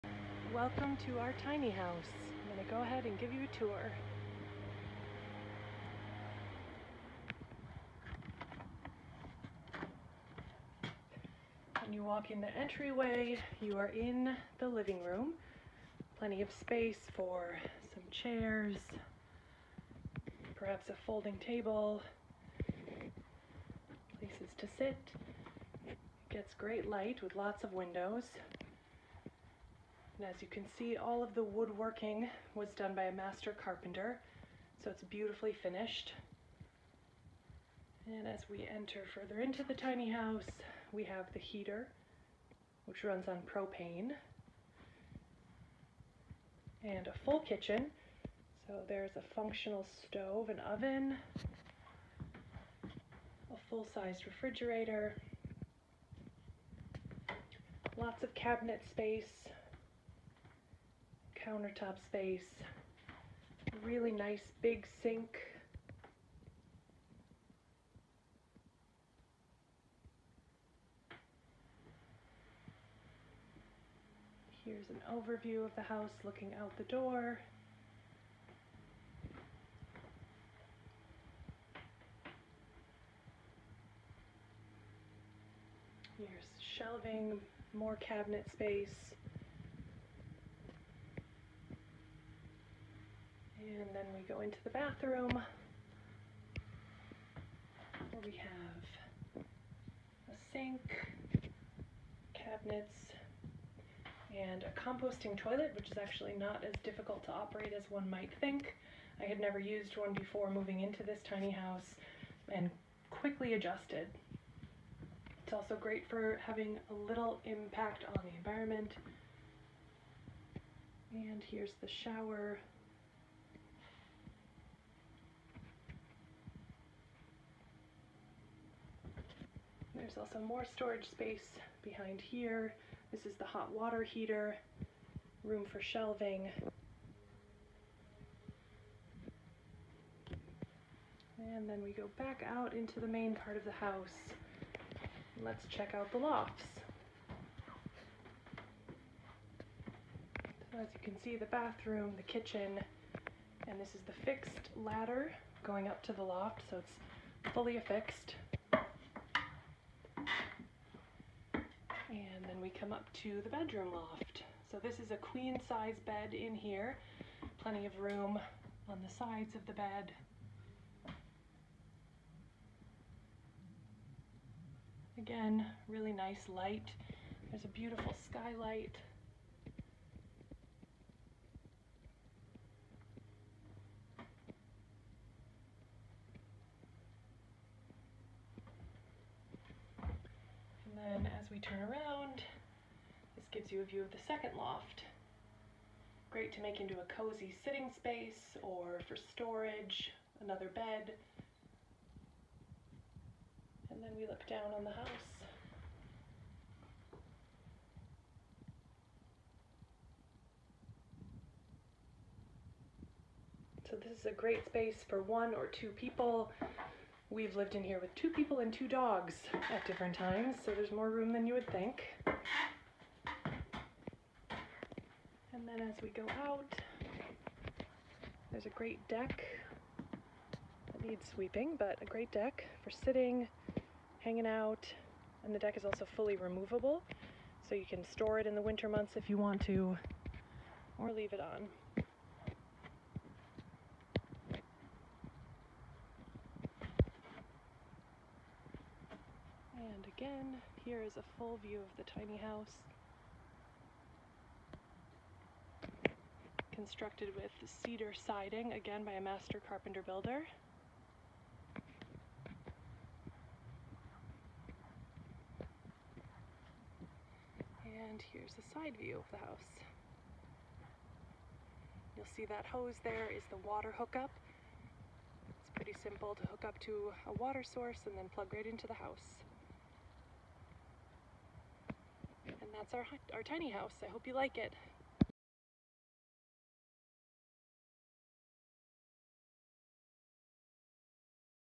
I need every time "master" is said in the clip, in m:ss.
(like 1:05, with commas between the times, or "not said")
0:33, 4:19.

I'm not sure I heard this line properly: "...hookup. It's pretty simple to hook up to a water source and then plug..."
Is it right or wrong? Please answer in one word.
right.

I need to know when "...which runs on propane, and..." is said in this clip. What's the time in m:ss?
0:42.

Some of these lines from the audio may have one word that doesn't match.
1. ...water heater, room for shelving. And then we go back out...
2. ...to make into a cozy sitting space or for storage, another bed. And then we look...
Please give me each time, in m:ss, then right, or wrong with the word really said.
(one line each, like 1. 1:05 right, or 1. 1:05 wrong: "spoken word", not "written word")
1. 2:13 right
2. 3:16 right.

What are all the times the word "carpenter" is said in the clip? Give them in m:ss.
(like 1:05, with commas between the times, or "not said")
0:33, 4:19.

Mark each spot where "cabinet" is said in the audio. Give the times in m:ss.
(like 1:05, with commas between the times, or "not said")
0:58, 1:28, 1:42.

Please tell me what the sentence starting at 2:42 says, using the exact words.
come up to the bedroom loft.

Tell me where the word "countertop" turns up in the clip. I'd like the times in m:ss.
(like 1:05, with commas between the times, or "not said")
1:01.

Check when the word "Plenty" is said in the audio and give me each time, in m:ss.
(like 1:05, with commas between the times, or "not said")
0:16, 2:47.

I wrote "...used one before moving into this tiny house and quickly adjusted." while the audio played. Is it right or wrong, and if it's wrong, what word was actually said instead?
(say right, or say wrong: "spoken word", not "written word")
right.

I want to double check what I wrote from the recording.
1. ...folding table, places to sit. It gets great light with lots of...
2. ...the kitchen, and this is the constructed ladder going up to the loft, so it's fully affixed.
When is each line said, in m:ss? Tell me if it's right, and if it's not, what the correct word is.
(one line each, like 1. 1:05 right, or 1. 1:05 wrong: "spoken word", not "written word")
1. 0:21 right
2. 2:32 wrong: "fixed", not "constructed".